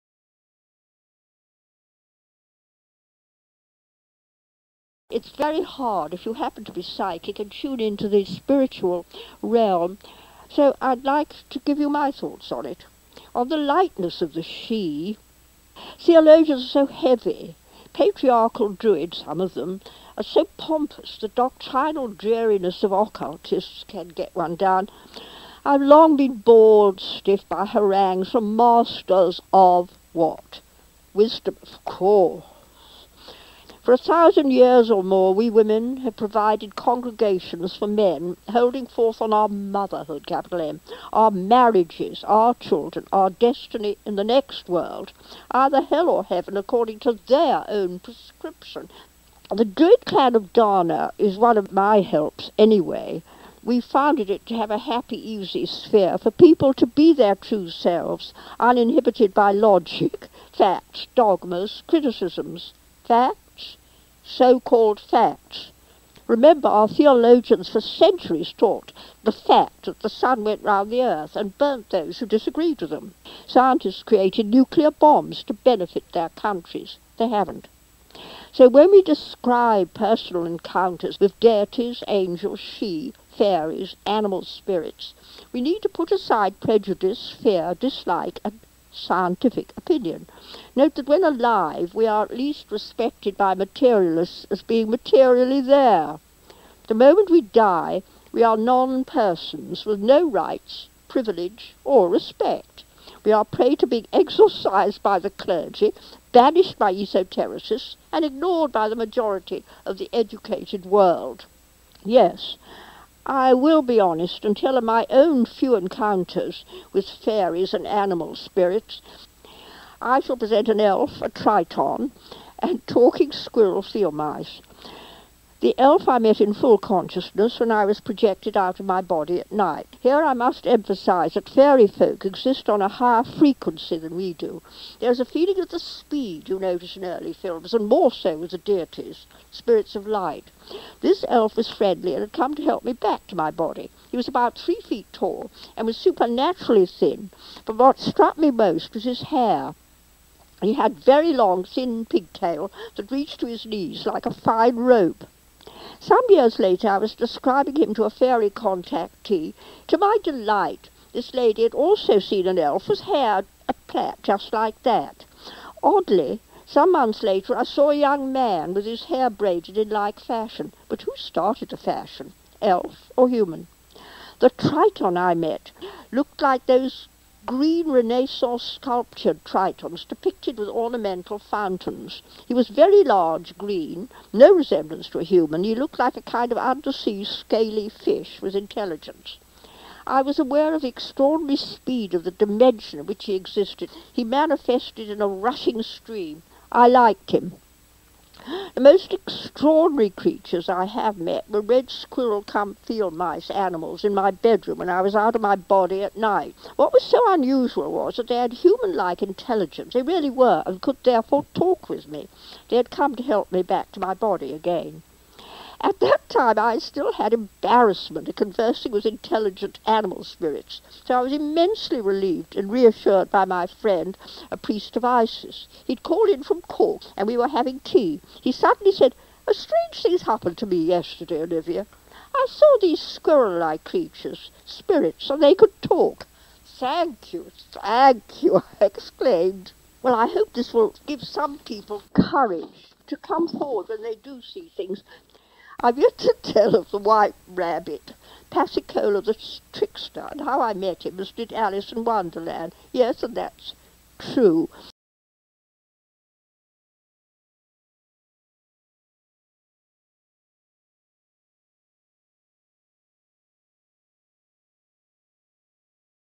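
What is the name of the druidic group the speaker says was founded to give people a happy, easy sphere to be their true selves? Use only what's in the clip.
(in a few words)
Druid clan of Dana.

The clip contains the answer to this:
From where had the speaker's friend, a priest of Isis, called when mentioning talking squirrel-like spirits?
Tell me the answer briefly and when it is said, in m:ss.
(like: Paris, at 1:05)
Cork, at 3:46.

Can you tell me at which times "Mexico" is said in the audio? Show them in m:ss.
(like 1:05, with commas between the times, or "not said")
not said.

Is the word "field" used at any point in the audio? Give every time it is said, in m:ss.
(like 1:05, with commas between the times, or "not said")
2:03, 3:22.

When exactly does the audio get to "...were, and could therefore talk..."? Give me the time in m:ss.
3:30.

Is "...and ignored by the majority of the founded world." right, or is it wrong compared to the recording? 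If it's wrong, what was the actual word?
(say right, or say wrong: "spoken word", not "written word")
wrong: "educated", not "founded".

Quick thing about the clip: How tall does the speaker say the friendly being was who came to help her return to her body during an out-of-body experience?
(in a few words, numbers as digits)
3 feet.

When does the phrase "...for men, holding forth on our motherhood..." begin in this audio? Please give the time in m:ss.
0:37.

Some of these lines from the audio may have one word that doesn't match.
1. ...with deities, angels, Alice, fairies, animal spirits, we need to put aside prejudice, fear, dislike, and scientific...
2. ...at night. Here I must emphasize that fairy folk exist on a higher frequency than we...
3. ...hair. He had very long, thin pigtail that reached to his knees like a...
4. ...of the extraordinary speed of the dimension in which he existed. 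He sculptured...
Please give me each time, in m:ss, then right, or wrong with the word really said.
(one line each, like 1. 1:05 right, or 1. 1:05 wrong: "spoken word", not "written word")
1. 1:21 wrong: "Sidhe", not "Alice"
2. 2:09 right
3. 2:29 right
4. 3:10 wrong: "manifested", not "sculptured".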